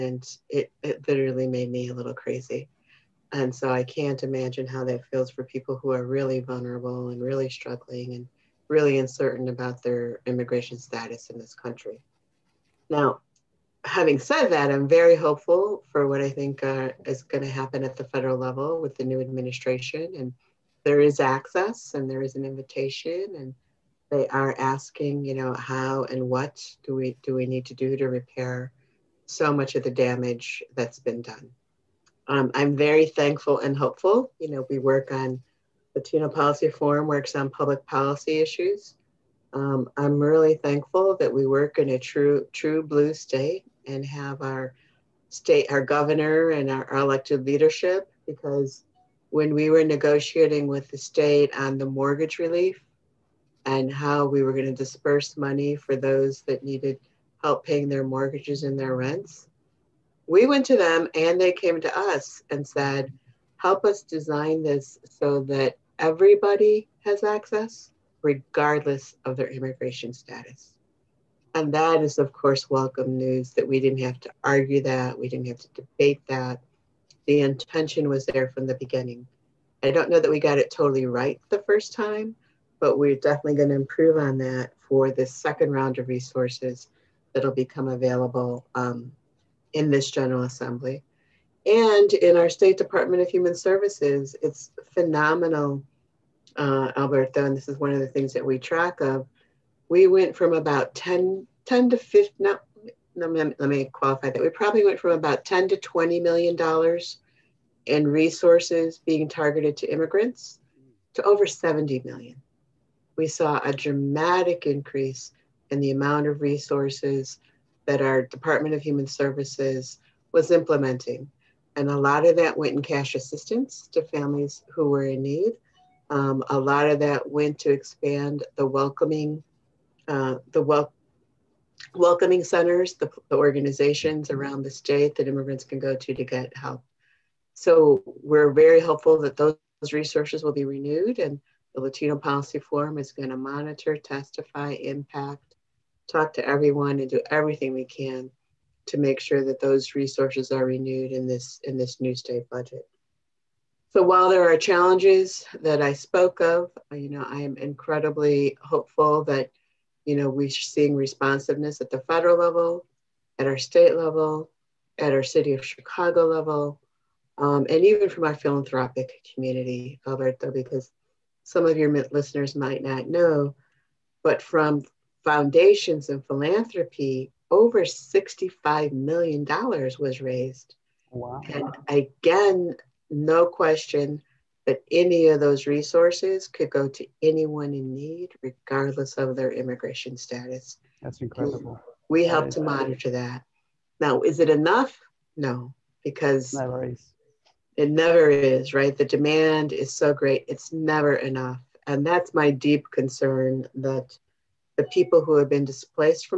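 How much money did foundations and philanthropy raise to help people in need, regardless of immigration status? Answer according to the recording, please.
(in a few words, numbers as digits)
over $65 million.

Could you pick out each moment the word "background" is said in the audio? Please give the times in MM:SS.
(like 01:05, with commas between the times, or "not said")
not said.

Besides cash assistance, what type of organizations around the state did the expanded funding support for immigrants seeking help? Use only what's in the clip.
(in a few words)
welcoming centers.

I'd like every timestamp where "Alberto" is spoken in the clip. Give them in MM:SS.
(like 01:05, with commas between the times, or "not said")
01:36, 02:50.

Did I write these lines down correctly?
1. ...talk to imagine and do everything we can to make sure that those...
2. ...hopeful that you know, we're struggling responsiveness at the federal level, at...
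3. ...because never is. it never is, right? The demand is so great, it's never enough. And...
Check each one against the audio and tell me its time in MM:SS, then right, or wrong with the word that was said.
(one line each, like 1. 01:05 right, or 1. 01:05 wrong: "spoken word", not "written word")
1. 02:26 wrong: "everyone", not "imagine"
2. 02:38 wrong: "seeing", not "struggling"
3. 03:16 right.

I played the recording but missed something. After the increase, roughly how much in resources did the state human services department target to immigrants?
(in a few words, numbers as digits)
over 70 million.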